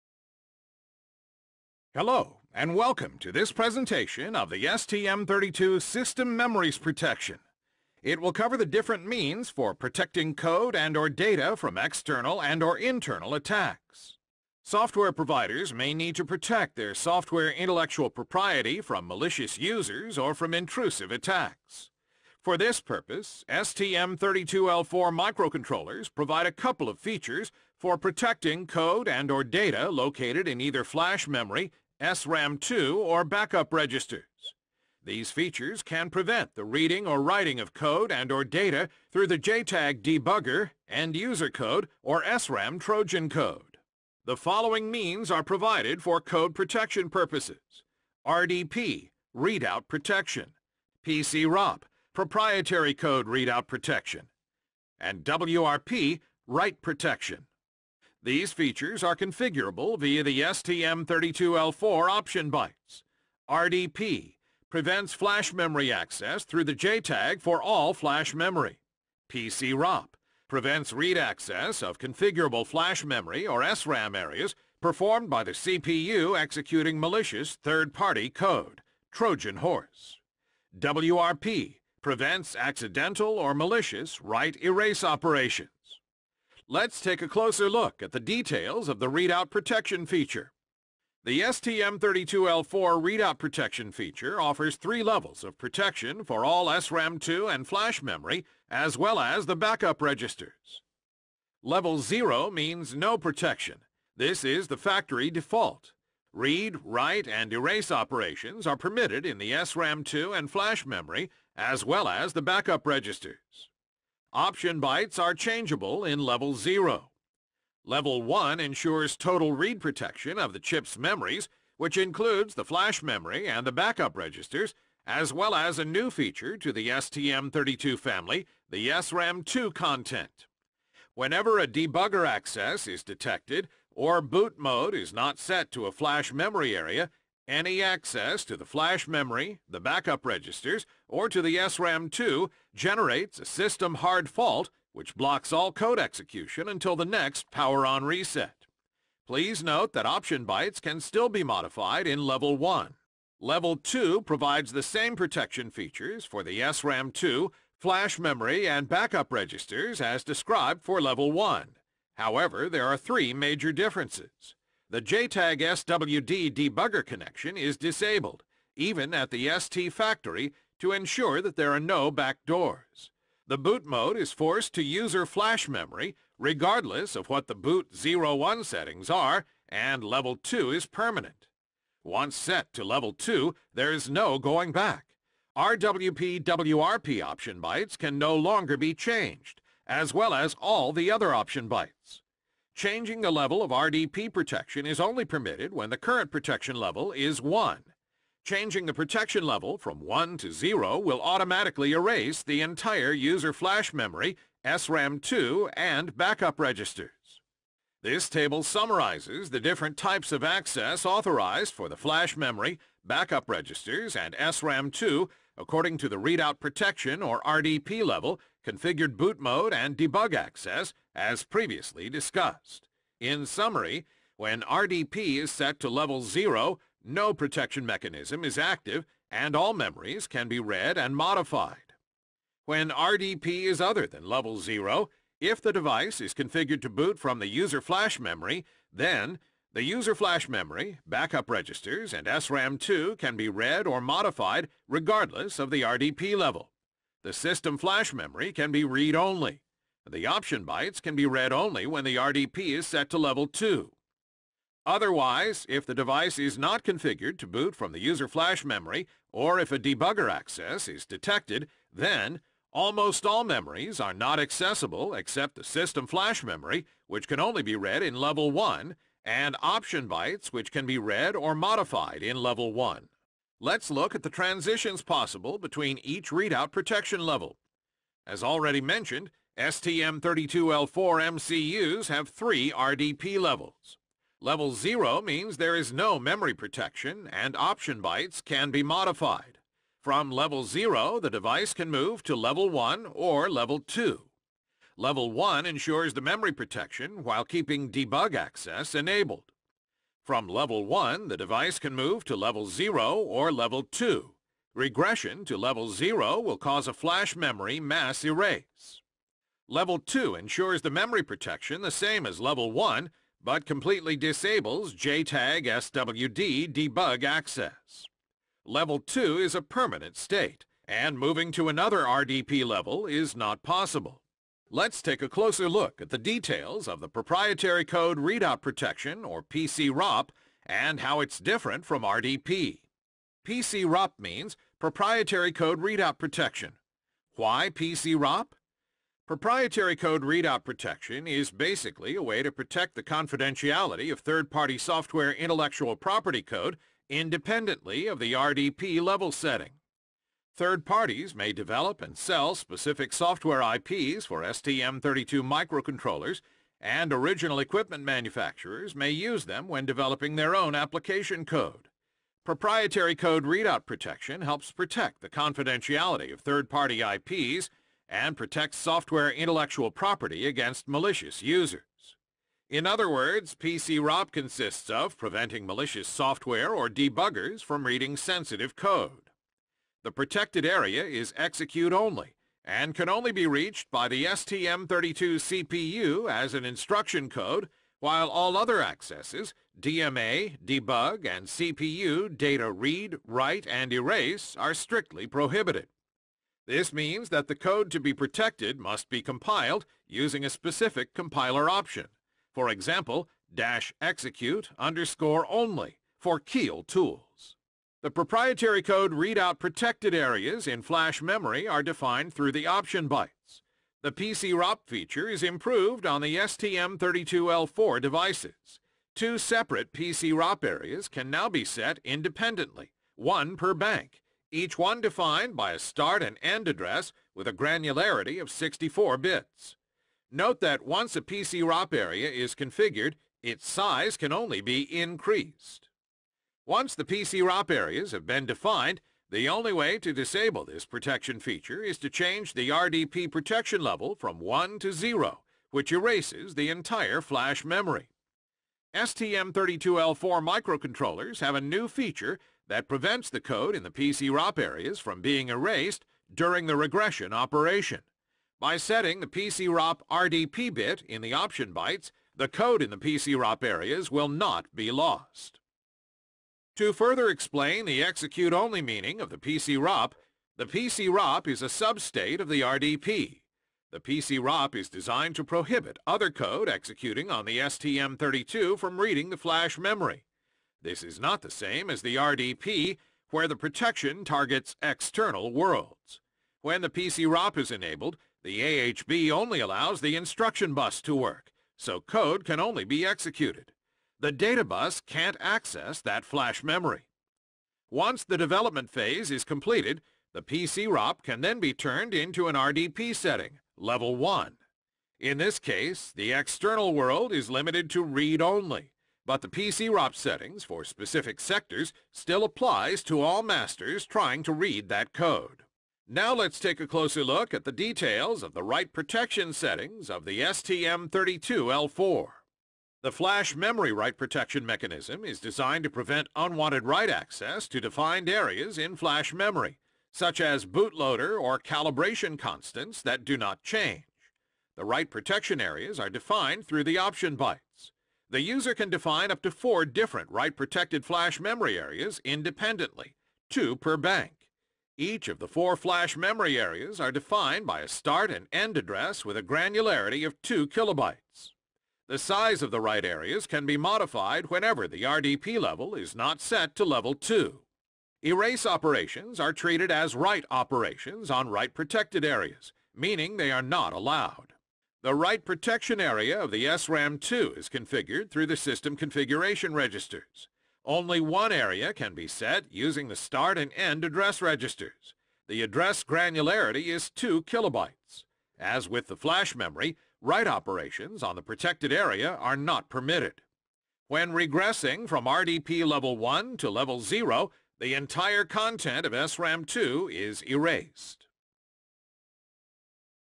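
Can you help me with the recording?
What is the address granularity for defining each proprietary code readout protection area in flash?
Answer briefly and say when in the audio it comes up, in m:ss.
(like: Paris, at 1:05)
64 bits, at 7:08.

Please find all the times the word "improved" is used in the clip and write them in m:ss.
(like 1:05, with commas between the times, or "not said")
6:55.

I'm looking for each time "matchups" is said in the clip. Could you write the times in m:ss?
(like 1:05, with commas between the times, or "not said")
not said.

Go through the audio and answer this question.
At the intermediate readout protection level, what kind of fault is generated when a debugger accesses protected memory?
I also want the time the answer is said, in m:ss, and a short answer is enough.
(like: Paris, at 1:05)
system hard fault, at 2:23.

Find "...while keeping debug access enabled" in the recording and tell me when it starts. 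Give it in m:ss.
4:57.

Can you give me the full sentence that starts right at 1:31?
The STM32L4 readout protection feature offers three levels of protection for all SRAM2 and flash memory, as well as the backup registers.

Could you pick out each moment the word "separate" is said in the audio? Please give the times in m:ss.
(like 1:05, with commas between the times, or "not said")
6:59.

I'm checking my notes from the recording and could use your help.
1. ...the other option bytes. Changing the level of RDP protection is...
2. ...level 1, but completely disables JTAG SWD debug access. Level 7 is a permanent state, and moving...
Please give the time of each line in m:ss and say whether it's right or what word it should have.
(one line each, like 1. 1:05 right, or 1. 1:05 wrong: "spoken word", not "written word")
1. 3:10 right
2. 5:12 wrong: "2", not "7".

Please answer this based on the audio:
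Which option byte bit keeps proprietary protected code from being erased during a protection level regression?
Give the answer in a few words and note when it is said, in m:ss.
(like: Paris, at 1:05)
PC-ROP RDP bit, at 7:39.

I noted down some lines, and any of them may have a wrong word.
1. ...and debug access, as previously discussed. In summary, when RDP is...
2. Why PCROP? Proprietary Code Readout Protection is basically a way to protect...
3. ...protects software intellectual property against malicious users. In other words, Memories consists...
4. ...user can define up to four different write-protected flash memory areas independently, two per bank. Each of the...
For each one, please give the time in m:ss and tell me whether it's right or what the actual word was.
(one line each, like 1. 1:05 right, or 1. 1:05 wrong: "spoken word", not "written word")
1. 3:39 right
2. 5:37 right
3. 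6:08 wrong: "PCROP", not "Memories"
4. 8:58 right.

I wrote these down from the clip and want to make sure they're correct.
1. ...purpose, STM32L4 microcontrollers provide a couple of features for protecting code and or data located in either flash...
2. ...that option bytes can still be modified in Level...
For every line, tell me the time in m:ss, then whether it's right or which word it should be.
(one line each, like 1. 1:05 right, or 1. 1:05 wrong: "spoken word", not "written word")
1. 0:22 right
2. 2:29 right.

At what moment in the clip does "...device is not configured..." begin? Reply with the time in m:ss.
4:15.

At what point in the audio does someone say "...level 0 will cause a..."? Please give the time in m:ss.
5:05.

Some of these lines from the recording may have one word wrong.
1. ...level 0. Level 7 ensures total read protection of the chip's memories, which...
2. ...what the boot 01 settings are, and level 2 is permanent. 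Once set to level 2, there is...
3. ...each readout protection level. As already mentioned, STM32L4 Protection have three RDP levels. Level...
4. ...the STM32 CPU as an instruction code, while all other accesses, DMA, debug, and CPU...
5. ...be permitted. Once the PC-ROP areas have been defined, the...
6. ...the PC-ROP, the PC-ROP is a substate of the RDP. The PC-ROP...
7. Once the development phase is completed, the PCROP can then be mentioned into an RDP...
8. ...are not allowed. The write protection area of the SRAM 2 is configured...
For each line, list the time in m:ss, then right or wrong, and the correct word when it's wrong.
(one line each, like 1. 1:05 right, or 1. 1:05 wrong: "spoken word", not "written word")
1. 1:56 wrong: "1", not "7"
2. 2:57 right
3. 4:36 wrong: "MCUs", not "Protection"
4. 6:24 right
5. 7:14 wrong: "increased", not "permitted"
6. 7:49 right
7. 8:17 wrong: "turned", not "mentioned"
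8. 9:23 right.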